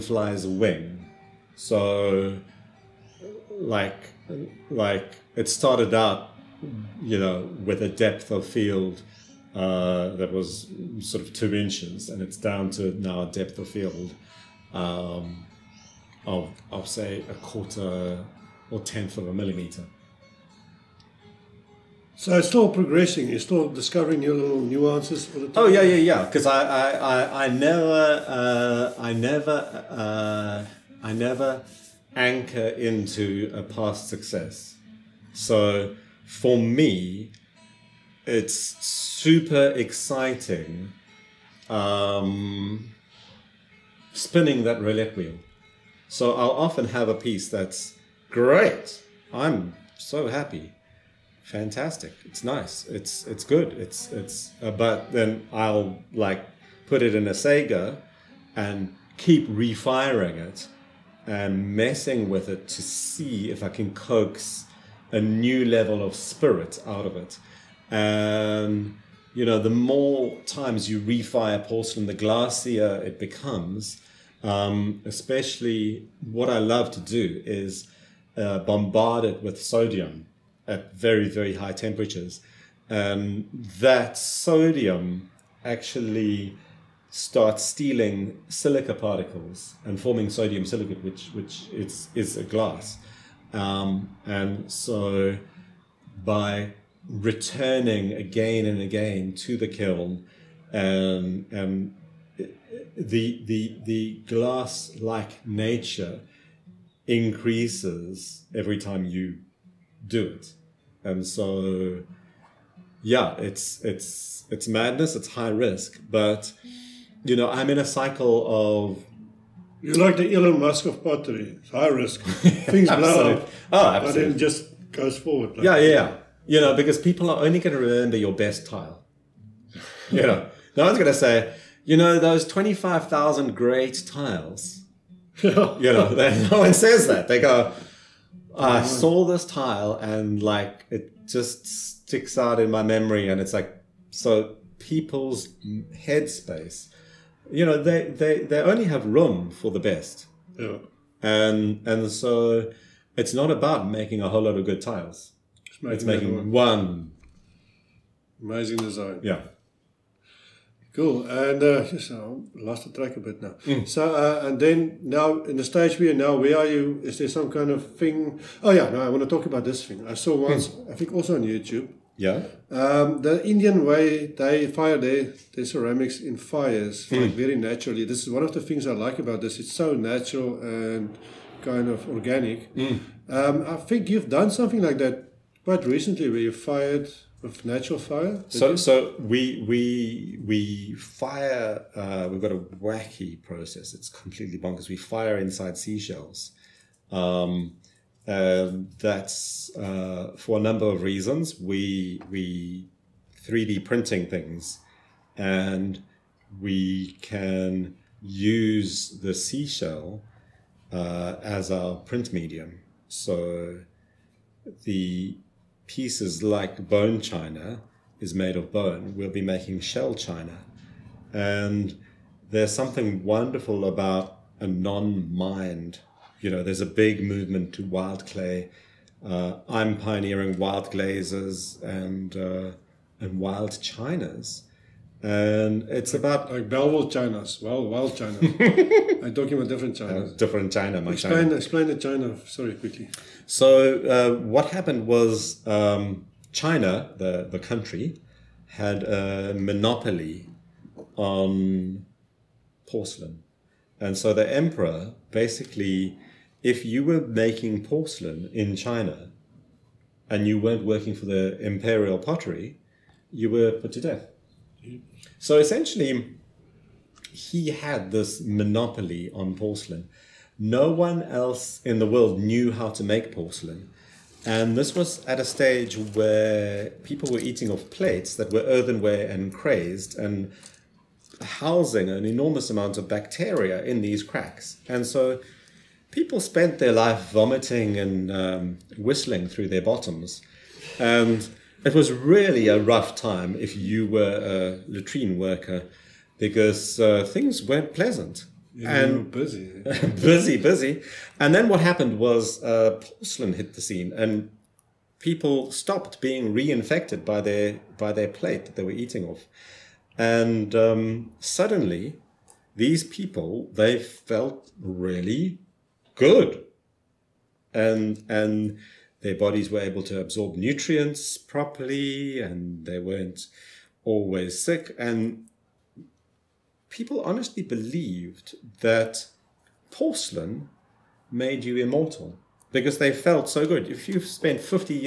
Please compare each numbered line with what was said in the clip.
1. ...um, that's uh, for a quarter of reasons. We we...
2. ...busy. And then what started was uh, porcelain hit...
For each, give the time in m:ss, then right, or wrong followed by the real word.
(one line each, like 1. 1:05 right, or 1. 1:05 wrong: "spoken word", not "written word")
1. 3:18 wrong: "number", not "quarter"
2. 5:00 wrong: "happened", not "started".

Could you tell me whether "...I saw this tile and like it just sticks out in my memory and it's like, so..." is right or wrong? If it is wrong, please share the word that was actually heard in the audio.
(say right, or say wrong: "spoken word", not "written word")
right.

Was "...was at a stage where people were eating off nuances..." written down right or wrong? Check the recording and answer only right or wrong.
wrong.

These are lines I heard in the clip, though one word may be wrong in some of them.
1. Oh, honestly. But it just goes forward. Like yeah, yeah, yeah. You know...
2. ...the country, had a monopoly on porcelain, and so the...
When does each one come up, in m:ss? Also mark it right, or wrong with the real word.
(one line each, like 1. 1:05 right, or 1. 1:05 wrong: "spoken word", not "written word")
1. 2:03 wrong: "absolutely", not "honestly"
2. 4:07 right.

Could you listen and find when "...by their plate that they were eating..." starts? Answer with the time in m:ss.
5:07.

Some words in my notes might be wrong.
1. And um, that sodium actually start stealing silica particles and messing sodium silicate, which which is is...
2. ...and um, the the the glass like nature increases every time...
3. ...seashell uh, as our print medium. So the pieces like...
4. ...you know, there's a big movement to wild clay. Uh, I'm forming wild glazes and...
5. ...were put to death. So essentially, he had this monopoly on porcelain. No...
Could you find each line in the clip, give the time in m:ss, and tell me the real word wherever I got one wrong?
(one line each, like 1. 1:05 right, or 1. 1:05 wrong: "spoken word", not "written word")
1. 1:22 wrong: "forming", not "messing"
2. 1:41 right
3. 3:29 right
4. 3:46 wrong: "pioneering", not "forming"
5. 4:23 right.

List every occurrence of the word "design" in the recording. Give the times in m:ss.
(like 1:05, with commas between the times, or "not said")
2:38.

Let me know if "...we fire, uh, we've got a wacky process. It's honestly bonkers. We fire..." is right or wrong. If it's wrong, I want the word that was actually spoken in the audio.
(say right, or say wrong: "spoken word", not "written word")
wrong: "completely", not "honestly".